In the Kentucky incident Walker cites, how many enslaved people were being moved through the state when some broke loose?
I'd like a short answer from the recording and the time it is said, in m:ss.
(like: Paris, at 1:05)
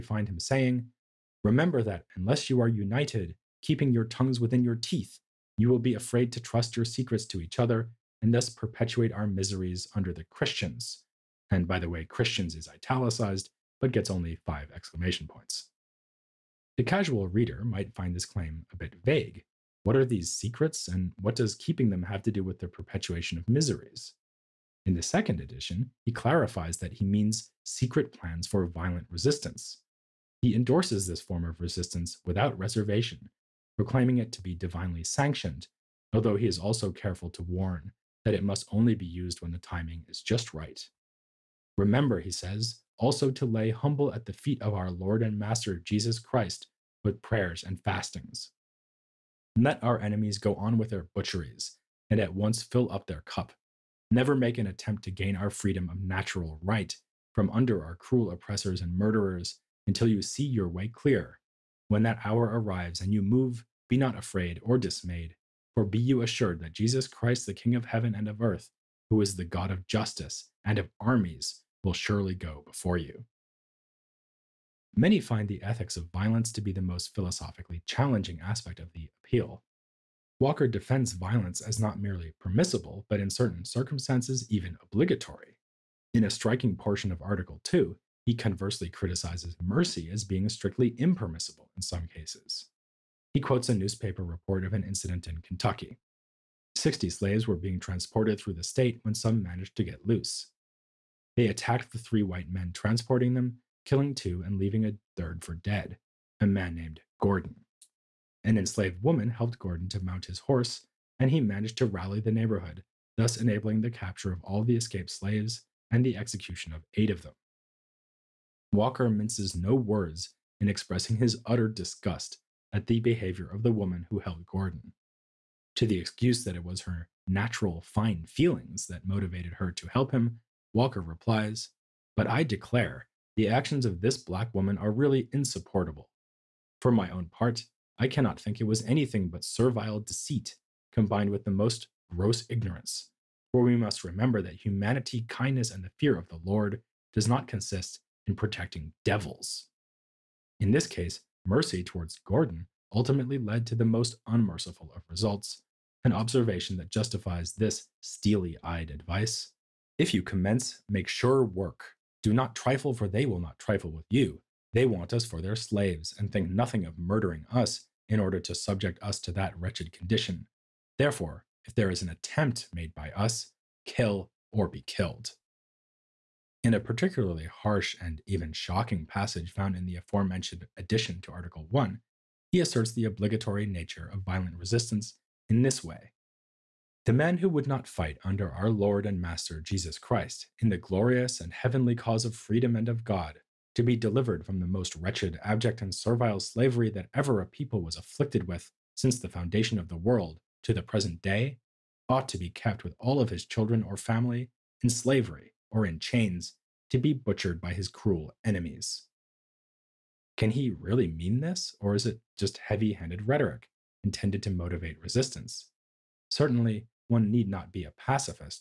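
60, at 1:36.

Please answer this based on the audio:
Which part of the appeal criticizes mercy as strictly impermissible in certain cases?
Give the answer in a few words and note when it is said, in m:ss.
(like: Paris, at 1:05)
Article 2, at 1:27.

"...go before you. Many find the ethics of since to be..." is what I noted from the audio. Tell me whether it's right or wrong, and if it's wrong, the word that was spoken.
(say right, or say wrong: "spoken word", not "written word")
wrong: "violence", not "since".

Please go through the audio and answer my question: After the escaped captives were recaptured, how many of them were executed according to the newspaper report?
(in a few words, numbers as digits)
8.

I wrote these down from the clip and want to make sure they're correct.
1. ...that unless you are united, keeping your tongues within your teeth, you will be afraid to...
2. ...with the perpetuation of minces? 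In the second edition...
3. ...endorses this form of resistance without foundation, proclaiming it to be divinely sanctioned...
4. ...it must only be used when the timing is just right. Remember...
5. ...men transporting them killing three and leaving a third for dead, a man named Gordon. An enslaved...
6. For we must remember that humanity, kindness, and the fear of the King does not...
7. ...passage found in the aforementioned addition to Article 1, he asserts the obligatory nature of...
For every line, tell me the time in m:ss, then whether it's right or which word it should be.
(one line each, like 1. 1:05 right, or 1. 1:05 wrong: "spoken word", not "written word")
1. 0:01 right
2. 0:22 wrong: "miseries", not "minces"
3. 0:30 wrong: "reservation", not "foundation"
4. 0:38 right
5. 1:42 wrong: "two", not "three"
6. 2:23 wrong: "Lord", not "King"
7. 2:59 right.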